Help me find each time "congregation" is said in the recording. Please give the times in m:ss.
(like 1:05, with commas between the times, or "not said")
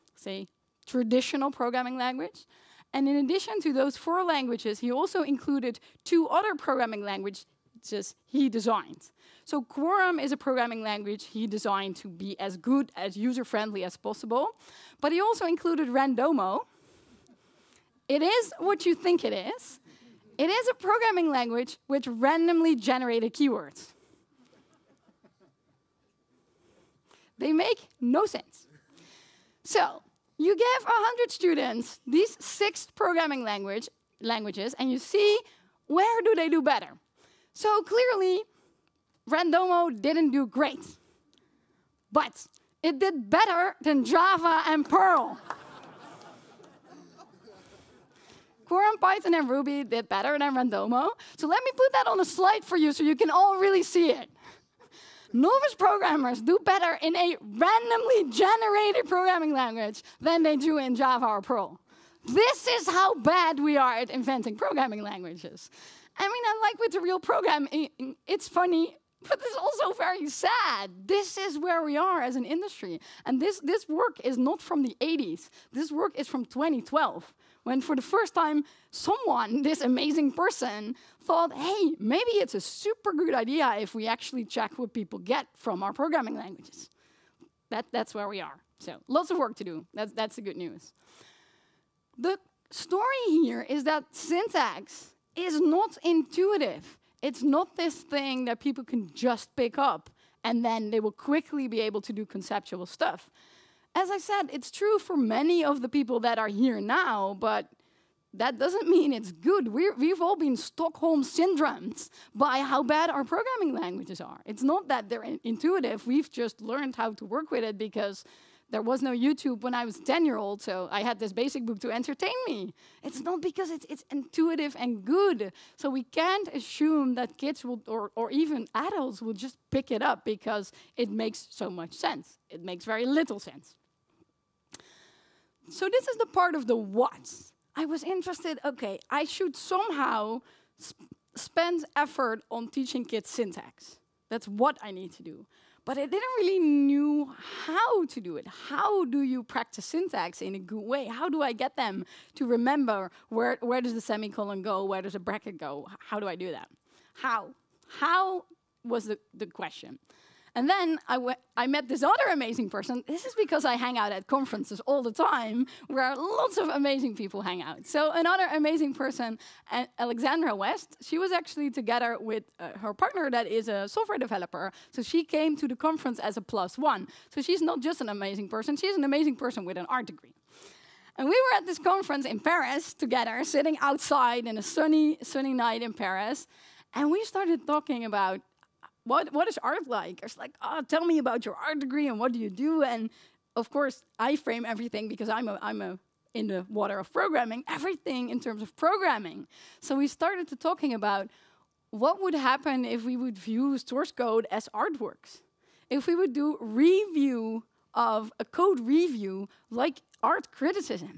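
not said.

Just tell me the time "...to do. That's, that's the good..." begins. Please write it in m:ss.
1:29.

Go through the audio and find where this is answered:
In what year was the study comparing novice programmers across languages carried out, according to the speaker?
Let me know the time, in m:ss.
1:16.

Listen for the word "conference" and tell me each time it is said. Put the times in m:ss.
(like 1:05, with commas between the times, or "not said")
2:44, 2:55, 3:01.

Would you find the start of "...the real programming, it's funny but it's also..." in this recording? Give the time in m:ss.
1:06.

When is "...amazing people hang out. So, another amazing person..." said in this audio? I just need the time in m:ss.
2:46.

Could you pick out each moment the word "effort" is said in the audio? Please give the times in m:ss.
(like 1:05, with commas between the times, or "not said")
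2:21.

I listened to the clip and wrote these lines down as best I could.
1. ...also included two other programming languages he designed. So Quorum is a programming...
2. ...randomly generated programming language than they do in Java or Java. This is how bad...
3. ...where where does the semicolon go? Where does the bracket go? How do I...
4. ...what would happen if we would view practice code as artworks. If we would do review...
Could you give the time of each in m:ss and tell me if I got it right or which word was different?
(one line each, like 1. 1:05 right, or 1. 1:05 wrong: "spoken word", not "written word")
1. 0:04 right
2. 0:57 wrong: "Perl", not "Java"
3. 2:33 right
4. 3:21 wrong: "source", not "practice".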